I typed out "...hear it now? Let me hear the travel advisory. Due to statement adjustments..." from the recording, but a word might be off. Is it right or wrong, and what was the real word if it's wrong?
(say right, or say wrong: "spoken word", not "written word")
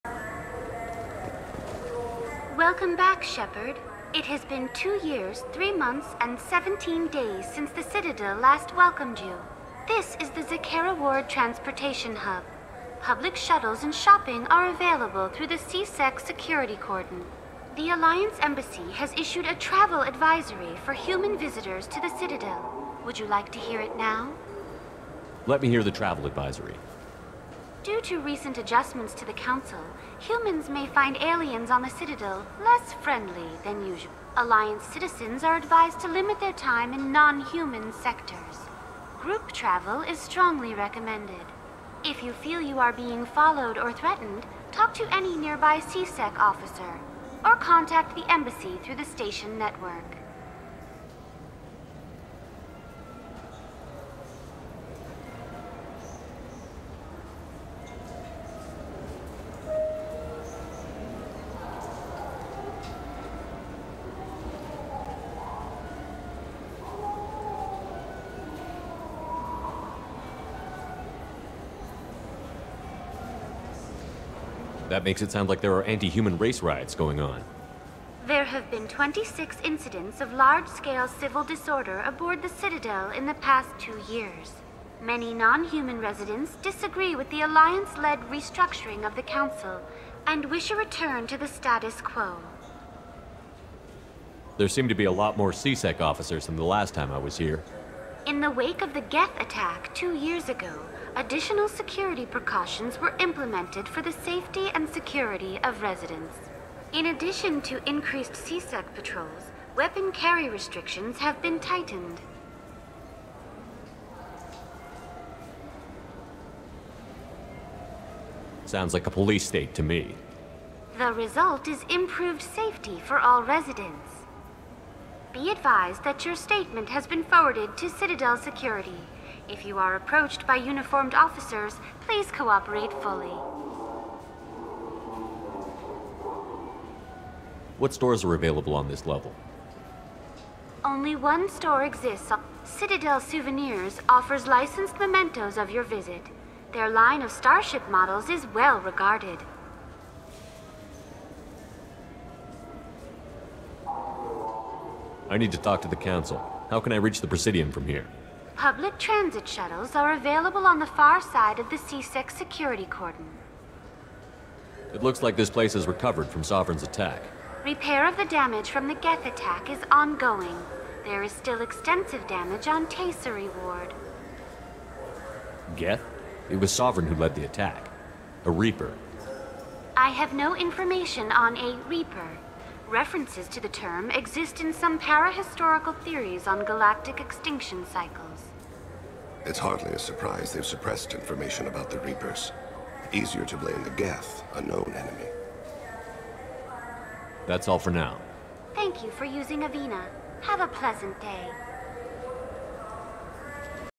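wrong: "recent", not "statement".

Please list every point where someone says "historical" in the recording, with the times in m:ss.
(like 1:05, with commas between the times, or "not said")
3:04.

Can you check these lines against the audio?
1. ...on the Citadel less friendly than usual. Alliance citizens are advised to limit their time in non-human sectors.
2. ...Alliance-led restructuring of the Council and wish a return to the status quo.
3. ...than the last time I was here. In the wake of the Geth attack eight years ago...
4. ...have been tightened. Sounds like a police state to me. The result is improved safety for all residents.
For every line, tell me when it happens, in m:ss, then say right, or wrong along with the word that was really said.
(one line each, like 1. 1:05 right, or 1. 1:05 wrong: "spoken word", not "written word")
1. 0:31 right
2. 1:27 right
3. 1:36 wrong: "two", not "eight"
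4. 1:51 right.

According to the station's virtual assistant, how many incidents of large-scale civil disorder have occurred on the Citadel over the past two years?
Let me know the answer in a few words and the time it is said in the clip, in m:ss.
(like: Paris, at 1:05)
26, at 1:18.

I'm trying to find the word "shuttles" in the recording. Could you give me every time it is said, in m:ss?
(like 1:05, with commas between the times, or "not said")
0:13, 2:39.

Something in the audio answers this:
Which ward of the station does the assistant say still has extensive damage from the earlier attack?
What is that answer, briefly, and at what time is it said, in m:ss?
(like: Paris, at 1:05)
Tayseri Ward, at 2:52.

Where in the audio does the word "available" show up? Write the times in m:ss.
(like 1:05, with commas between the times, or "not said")
0:14, 2:18, 2:40.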